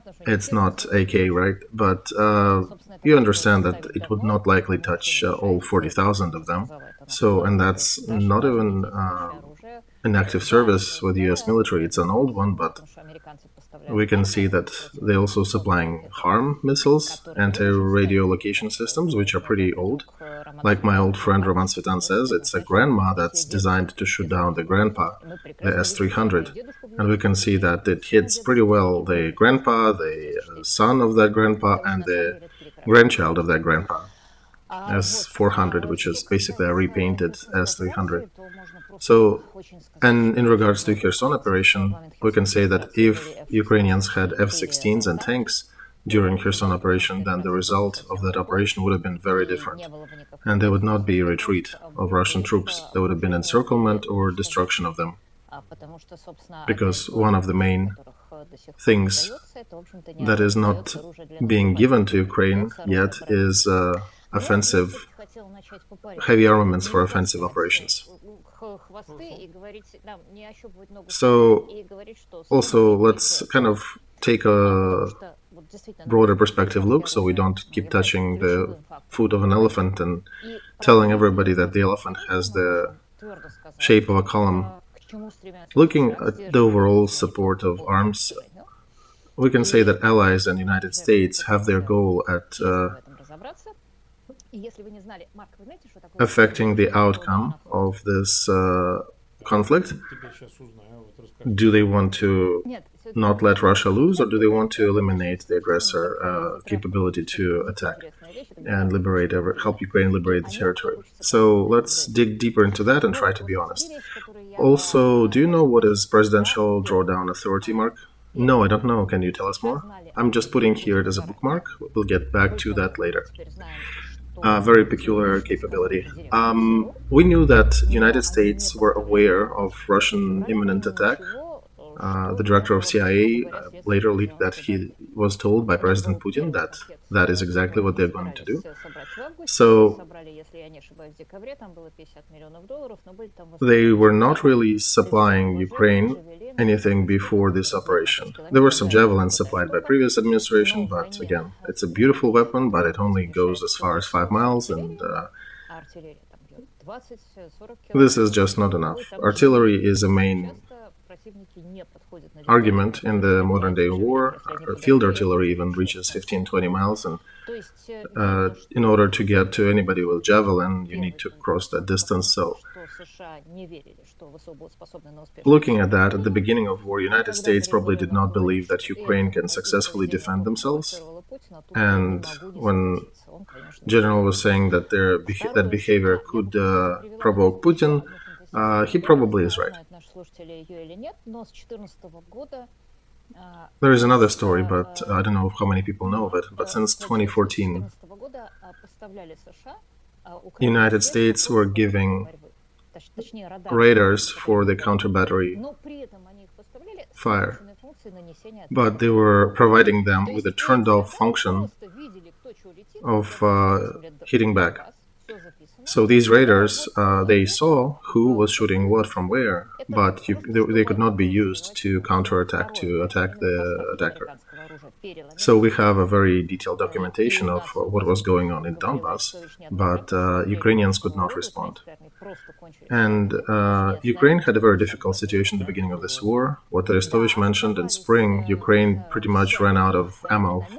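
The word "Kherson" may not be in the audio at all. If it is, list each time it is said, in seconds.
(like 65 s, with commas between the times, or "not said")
40 s, 46 s.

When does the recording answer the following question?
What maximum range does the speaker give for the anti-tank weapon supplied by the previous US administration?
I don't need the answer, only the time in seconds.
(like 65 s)
154 s.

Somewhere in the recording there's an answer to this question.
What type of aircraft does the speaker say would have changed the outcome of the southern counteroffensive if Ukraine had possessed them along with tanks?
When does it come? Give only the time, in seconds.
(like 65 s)
44 s.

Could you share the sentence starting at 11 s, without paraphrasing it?
It's an old one, but we can see that they're also supplying HARM missiles, anti-radio location systems, which are pretty old.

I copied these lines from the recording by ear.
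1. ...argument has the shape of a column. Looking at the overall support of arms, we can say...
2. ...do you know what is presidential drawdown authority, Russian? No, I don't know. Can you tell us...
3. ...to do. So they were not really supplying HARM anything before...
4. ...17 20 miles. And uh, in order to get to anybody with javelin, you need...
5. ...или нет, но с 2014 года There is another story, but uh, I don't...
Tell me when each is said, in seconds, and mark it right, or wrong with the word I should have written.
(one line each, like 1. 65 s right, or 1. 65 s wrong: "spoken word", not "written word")
1. 81 s wrong: "elephant", not "argument"
2. 115 s wrong: "Mark", not "Russian"
3. 138 s wrong: "Ukraine", not "HARM"
4. 166 s wrong: "15", not "17"
5. 190 s right.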